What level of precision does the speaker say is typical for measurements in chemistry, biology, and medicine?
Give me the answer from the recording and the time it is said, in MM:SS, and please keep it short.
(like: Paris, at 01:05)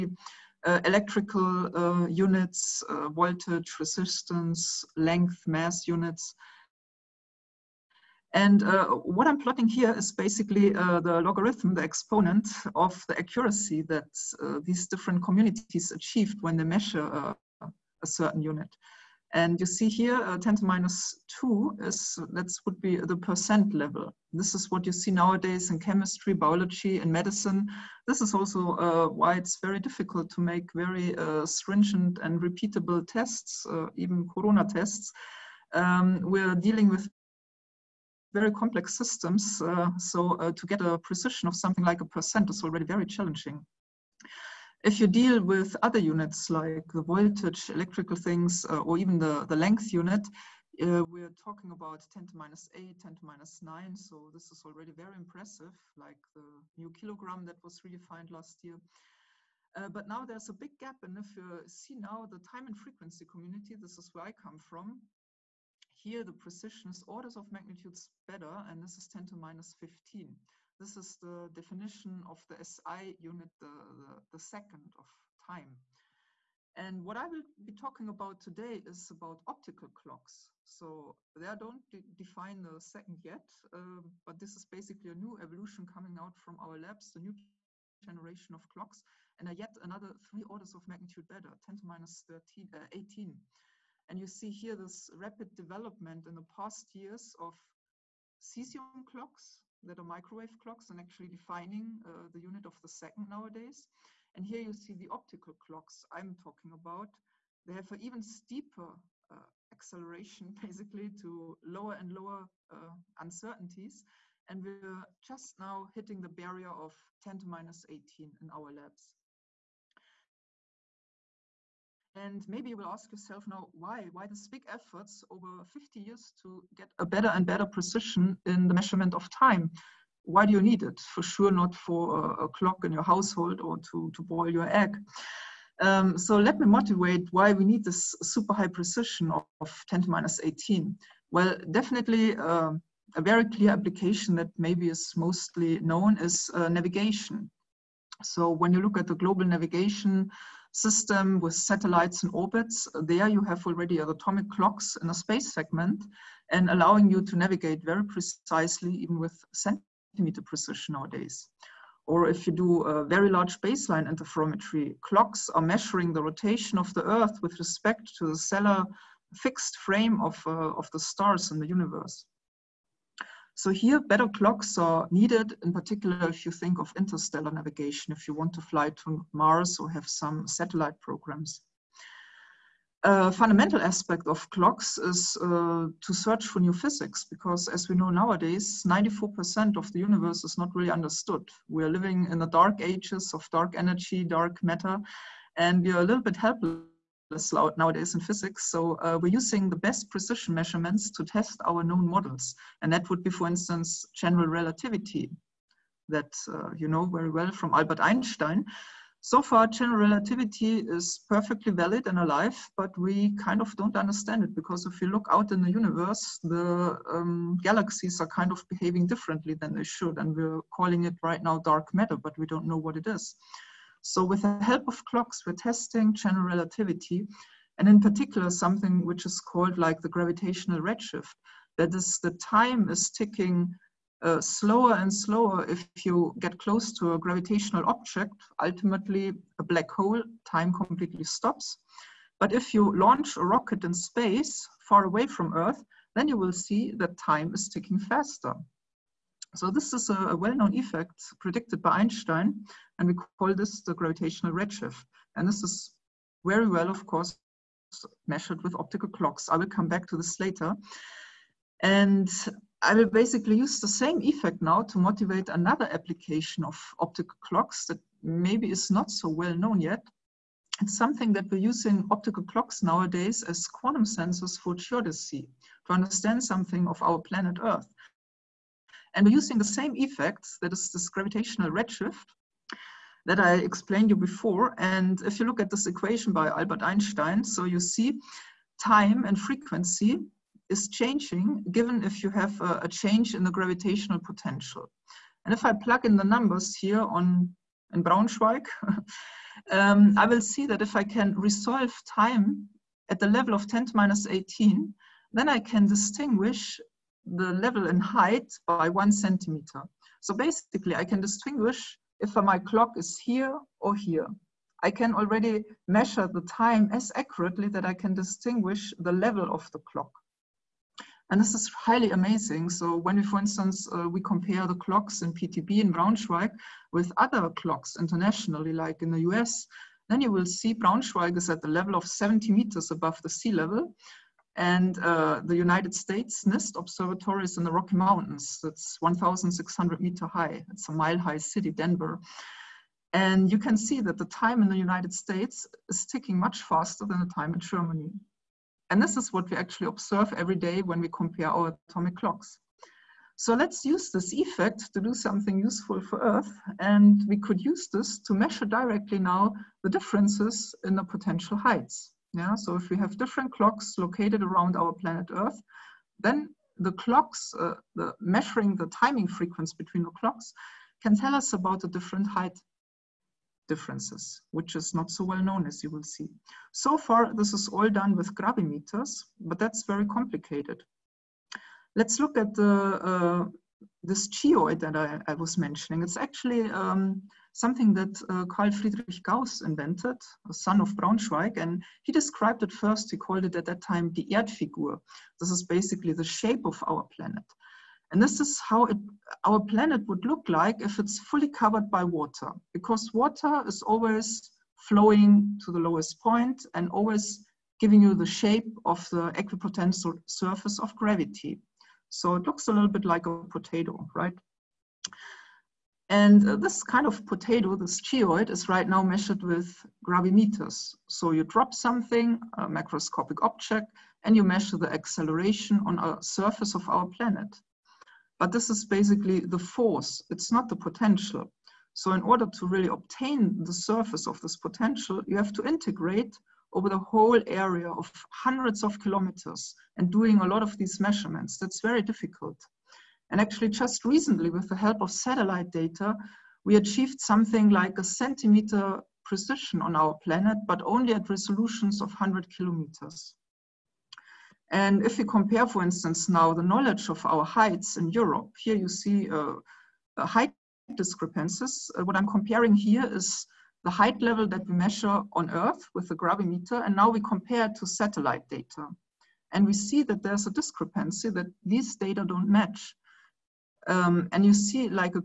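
10 to minus 2 (percent level), at 00:20.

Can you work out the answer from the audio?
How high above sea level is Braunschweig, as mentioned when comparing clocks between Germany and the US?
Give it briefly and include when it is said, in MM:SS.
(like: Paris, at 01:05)
70 meters, at 05:32.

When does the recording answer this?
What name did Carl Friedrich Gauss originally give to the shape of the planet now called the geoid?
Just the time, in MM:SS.
06:34.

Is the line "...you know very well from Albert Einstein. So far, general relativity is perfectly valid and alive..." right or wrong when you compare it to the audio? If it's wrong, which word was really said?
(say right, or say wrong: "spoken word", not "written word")
right.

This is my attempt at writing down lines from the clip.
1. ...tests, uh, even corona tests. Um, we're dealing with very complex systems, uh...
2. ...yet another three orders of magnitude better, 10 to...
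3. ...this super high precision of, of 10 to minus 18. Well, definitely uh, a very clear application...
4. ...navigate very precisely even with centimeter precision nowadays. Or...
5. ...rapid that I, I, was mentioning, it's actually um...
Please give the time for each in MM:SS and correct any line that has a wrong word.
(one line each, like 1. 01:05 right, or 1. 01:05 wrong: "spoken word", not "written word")
1. 00:33 right
2. 01:29 right
3. 02:17 right
4. 02:37 right
5. 06:24 wrong: "geoid", not "rapid".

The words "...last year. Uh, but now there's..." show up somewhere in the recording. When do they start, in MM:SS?
00:58.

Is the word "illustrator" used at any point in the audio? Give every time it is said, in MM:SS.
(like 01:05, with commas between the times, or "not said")
not said.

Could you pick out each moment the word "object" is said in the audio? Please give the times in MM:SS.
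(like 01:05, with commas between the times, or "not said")
03:57, 07:03.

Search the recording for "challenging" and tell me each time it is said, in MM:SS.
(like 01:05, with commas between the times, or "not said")
00:43.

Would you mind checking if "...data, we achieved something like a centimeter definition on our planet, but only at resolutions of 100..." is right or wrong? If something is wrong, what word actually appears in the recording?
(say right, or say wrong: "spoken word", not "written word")
wrong: "precision", not "definition".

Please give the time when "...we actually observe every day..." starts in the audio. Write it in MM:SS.
05:49.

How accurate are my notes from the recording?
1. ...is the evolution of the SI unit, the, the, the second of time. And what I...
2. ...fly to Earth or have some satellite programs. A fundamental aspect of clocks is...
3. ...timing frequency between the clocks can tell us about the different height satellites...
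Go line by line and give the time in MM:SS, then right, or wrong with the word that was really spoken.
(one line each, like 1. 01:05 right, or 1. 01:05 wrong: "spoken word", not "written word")
1. 01:10 wrong: "definition", not "evolution"
2. 02:58 wrong: "Mars", not "Earth"
3. 06:08 wrong: "differences", not "satellites".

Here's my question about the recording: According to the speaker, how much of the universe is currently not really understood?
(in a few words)
94%.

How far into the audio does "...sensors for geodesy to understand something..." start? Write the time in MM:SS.
04:34.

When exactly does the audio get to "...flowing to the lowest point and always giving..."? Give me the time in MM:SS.
06:44.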